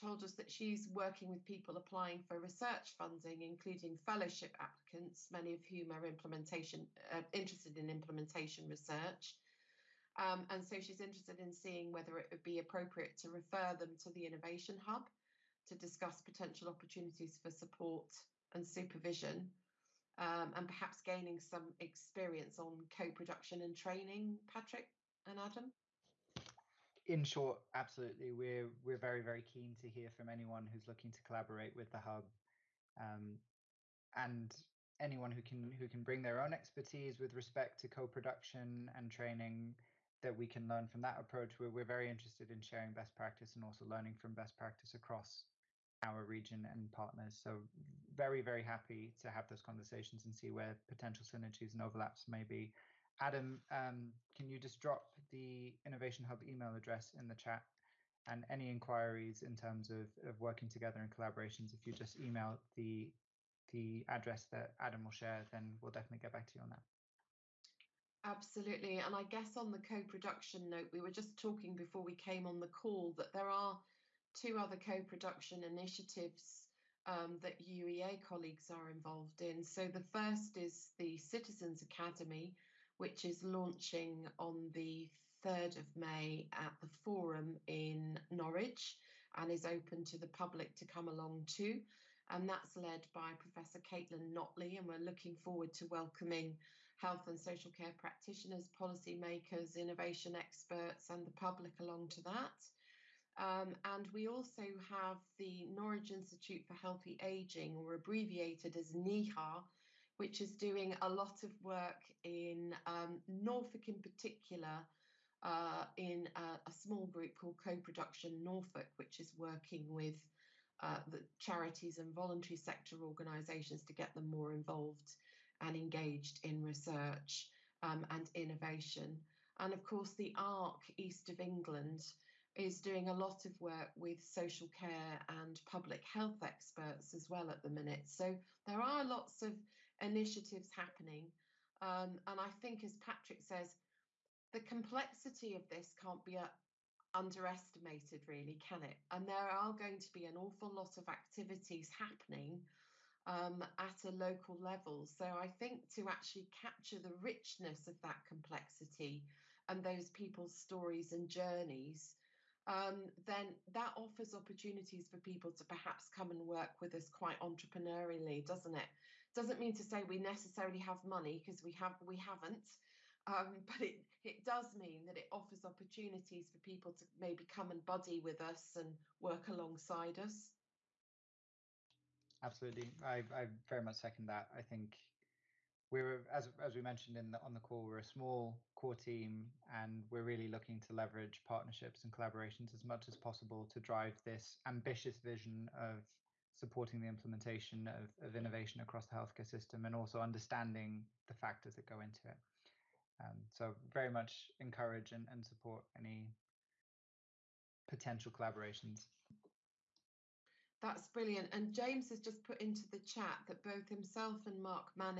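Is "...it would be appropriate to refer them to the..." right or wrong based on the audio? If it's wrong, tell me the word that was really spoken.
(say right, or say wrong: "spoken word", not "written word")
right.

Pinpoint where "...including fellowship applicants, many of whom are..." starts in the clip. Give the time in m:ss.
0:03.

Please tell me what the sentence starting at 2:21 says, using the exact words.
Um, and I think, as Patrick says, the complexity of this can't be underestimated, really, can it?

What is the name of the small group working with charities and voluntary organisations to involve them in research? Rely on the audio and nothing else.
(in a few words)
Co Production Norfolk.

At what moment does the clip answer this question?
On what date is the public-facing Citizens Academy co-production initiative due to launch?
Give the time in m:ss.
1:25.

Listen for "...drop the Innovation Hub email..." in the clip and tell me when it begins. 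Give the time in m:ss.
0:54.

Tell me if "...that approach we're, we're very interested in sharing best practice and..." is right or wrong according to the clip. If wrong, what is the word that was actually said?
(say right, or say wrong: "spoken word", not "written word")
right.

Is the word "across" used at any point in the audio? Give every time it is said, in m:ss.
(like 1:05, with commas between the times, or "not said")
0:44, 3:18.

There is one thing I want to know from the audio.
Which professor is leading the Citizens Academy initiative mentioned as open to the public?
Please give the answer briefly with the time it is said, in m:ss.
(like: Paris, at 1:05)
Caitlin Notley, at 1:33.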